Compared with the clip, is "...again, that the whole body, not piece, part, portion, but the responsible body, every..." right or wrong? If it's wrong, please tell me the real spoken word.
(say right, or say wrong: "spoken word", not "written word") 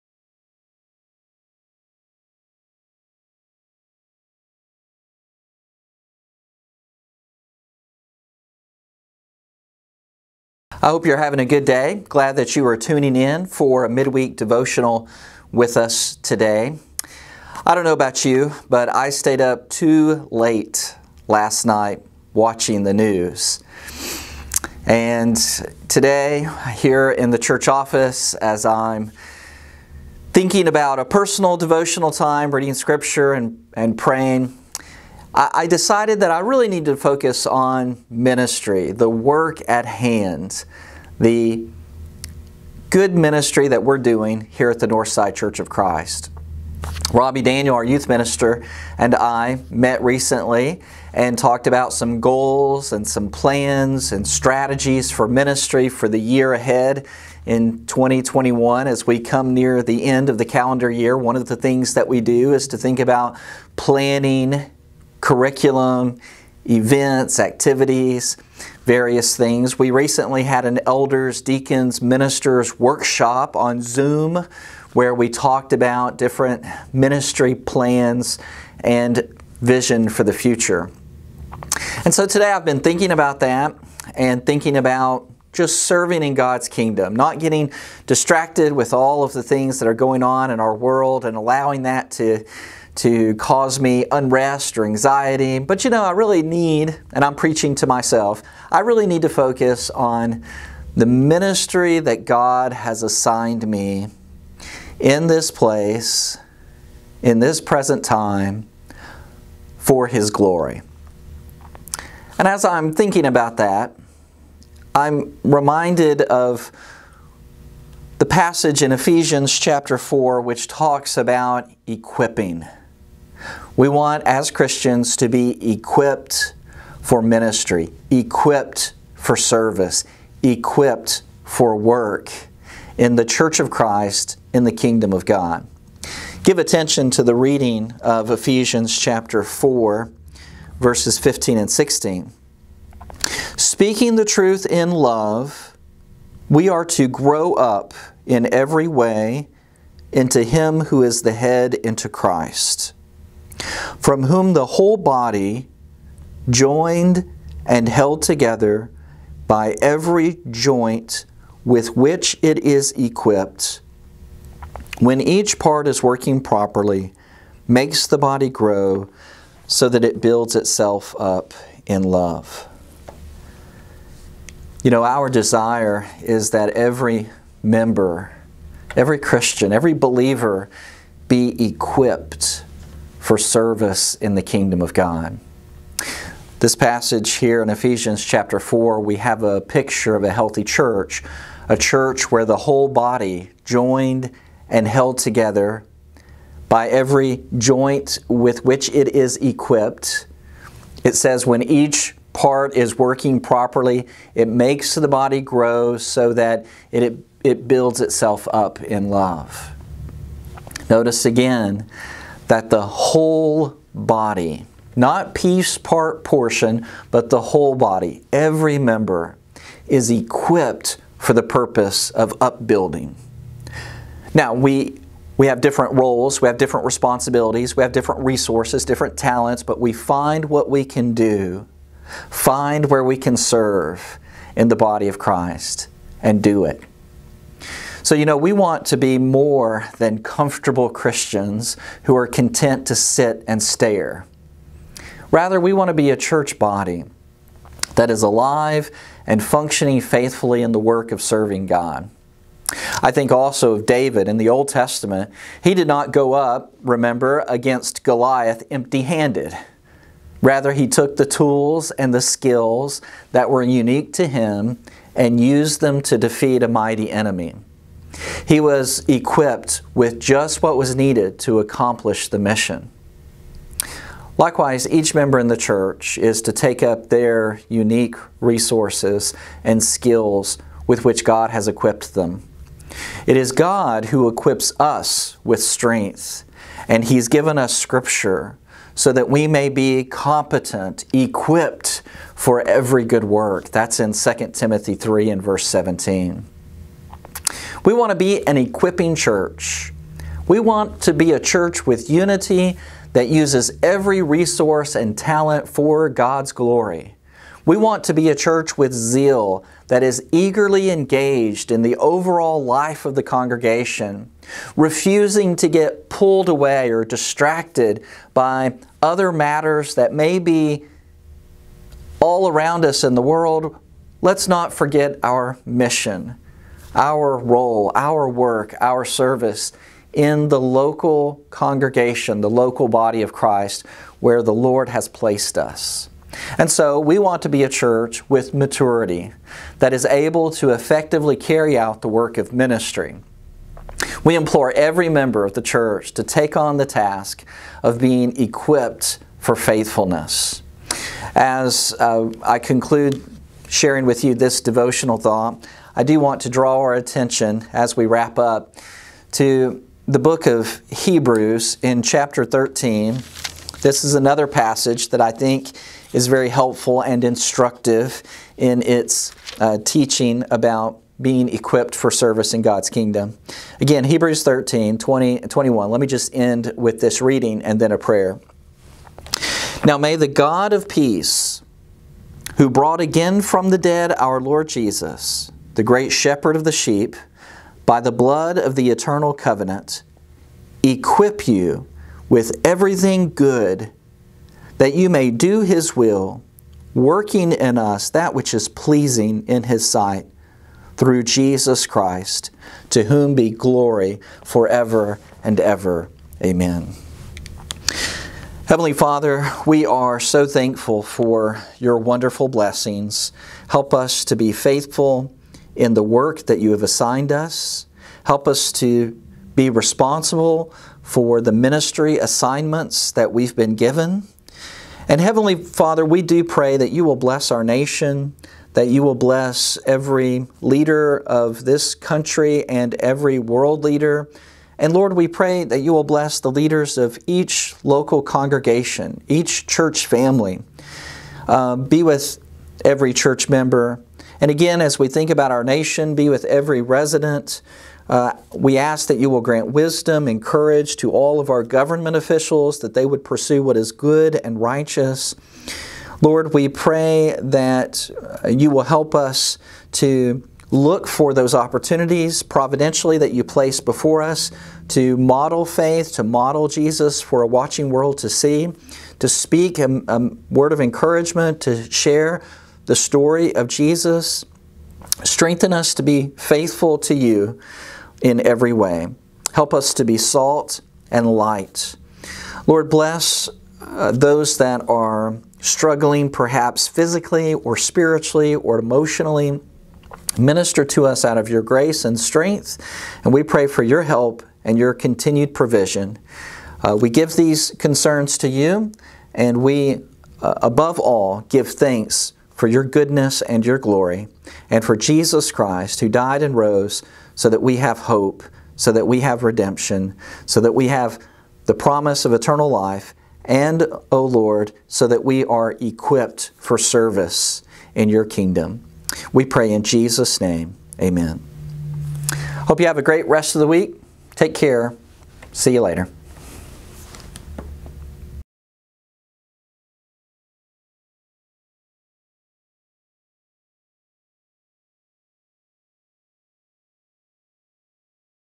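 wrong: "whole", not "responsible".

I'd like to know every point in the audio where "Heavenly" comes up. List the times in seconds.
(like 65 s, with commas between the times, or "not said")
408 s, 425 s.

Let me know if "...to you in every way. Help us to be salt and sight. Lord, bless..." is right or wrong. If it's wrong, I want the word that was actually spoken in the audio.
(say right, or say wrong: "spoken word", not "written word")
wrong: "light", not "sight".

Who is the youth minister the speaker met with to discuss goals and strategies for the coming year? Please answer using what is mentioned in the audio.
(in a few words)
Robbie Daniel.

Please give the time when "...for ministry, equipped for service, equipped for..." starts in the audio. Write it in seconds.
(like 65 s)
127 s.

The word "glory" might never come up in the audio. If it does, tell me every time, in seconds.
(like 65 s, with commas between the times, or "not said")
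110 s, 306 s, 403 s, 503 s.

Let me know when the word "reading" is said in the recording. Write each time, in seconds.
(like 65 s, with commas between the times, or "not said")
32 s, 137 s, 377 s.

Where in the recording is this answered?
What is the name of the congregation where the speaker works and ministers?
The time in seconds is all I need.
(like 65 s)
44 s.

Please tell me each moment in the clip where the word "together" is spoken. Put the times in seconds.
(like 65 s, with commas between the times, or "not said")
158 s, 195 s.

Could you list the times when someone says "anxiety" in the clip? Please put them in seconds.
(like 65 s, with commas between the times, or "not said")
94 s.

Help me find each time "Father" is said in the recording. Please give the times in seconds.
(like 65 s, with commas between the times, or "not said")
408 s, 425 s.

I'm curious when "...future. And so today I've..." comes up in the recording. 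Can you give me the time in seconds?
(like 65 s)
80 s.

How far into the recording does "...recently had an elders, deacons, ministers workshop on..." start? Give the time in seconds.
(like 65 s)
69 s.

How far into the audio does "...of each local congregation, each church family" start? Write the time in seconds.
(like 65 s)
436 s.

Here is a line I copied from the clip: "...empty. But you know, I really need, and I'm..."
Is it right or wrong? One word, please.
wrong.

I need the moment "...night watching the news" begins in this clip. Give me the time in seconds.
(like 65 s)
21 s.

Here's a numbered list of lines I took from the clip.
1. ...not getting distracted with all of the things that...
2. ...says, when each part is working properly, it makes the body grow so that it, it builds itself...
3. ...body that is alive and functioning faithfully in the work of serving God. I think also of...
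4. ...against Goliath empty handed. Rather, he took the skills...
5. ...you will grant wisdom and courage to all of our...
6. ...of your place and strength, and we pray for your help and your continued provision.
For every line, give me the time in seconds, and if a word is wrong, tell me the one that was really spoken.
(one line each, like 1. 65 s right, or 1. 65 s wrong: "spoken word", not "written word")
1. 87 s right
2. 201 s right
3. 246 s right
4. 257 s wrong: "tools", not "skills"
5. 449 s right
6. 491 s wrong: "grace", not "place".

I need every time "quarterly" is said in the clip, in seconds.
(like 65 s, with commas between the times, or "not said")
not said.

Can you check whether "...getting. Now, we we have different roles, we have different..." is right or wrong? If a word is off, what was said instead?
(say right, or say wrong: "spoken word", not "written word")
wrong: "upbuilding", not "getting".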